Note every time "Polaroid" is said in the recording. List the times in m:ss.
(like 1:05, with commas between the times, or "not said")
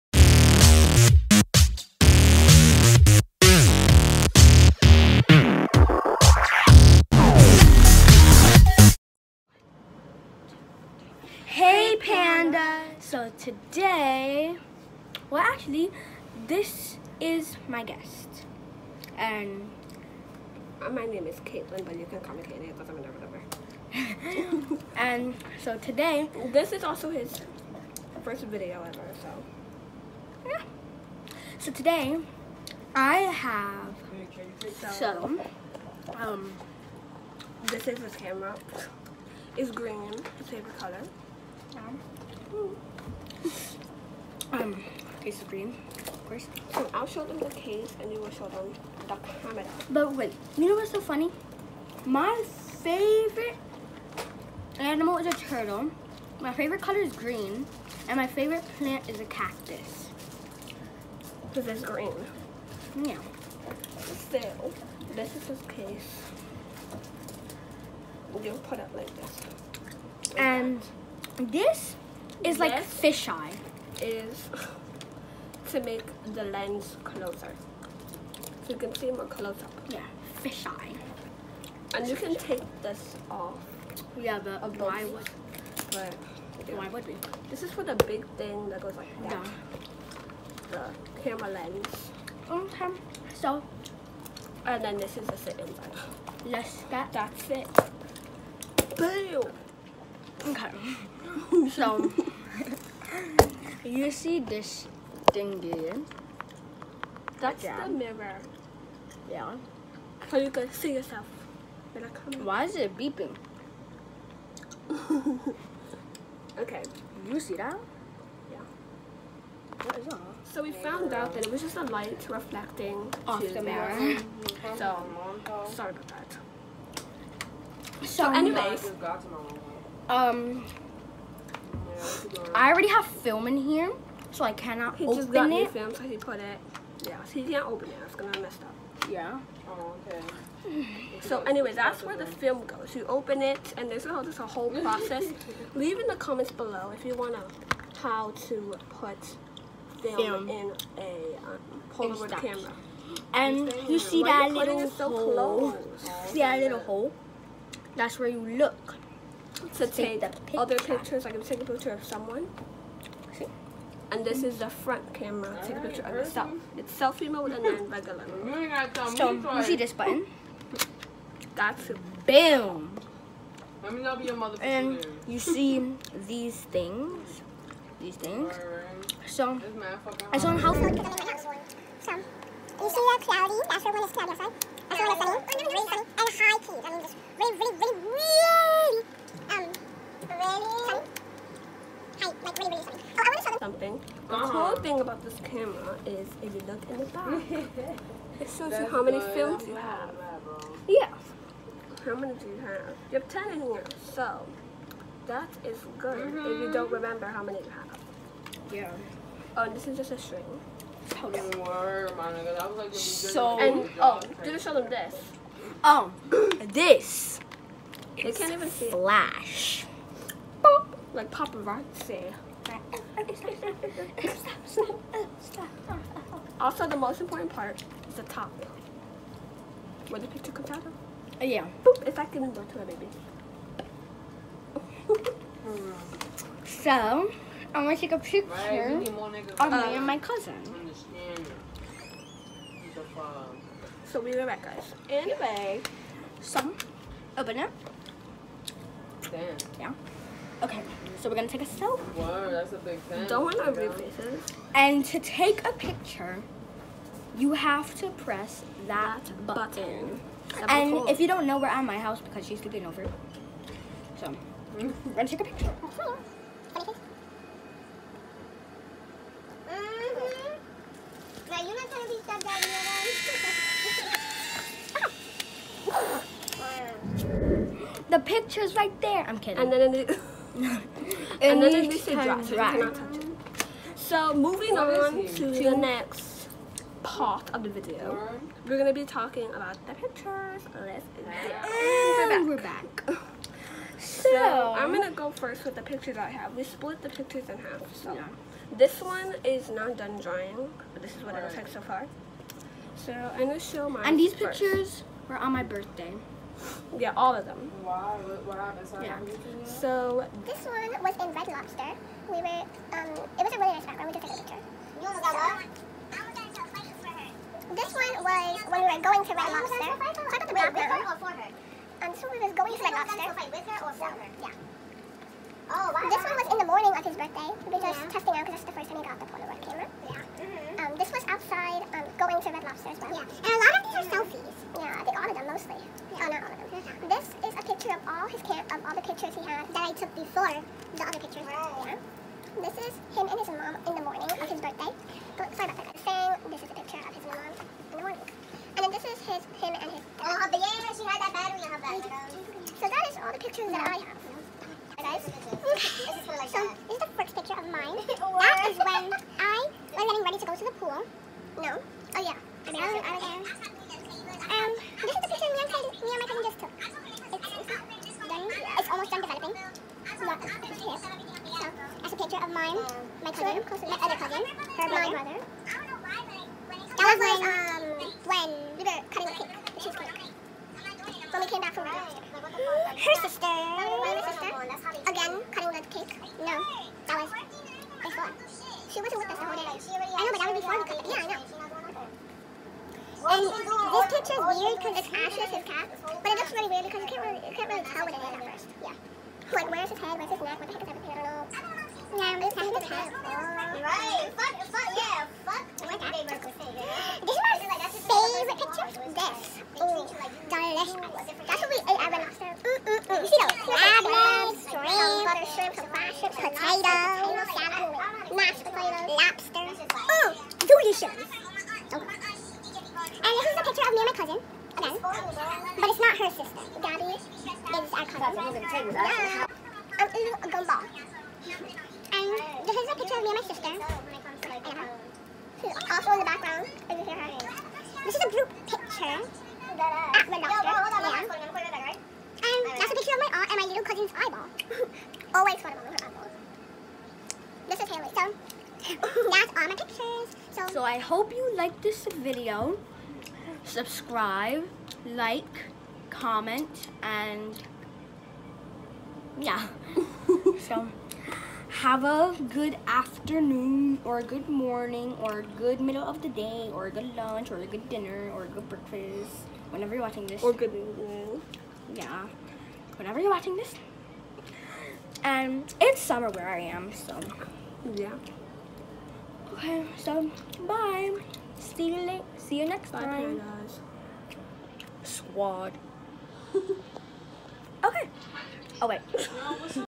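2:31, 5:29.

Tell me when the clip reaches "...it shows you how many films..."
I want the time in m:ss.
3:18.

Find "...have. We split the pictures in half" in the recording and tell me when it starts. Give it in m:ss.
4:56.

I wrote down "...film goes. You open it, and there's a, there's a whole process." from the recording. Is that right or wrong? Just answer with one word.
right.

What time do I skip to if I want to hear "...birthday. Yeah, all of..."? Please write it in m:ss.
5:05.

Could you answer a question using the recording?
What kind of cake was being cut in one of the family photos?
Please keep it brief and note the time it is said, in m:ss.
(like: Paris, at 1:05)
Cheesecake, at 6:19.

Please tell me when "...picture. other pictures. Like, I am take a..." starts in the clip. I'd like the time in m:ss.
2:40.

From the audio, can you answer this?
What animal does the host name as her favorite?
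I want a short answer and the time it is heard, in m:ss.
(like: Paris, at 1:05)
Turtle, at 0:52.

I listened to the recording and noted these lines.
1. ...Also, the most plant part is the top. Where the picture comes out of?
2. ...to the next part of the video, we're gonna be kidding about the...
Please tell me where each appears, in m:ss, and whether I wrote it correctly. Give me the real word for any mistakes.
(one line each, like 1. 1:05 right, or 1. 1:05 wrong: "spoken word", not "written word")
1. 3:46 wrong: "important", not "plant"
2. 4:45 wrong: "talking", not "kidding".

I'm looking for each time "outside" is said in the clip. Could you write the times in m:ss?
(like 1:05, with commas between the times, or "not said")
3:04, 5:31.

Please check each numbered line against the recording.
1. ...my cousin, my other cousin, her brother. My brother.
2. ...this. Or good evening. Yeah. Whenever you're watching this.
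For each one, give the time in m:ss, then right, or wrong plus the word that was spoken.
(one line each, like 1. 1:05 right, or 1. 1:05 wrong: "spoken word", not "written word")
1. 6:13 right
2. 7:50 right.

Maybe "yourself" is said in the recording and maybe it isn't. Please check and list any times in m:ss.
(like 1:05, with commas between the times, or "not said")
1:50, 2:46.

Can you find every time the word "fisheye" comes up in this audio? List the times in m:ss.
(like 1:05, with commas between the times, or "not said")
1:12, 1:20.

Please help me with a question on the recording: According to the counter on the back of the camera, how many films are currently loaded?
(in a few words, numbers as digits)
10.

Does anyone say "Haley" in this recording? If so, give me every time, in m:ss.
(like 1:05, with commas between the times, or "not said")
7:27.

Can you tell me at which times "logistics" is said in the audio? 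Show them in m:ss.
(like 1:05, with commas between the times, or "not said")
not said.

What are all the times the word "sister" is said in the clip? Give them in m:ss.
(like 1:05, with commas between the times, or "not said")
6:23, 7:13.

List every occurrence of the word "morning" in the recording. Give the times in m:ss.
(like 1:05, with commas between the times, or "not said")
5:26, 5:44, 5:48, 7:44.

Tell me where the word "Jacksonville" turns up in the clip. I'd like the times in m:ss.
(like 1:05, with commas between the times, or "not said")
not said.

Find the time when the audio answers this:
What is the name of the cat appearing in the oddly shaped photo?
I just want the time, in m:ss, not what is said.
6:35.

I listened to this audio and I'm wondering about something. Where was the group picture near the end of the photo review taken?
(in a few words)
The doctor.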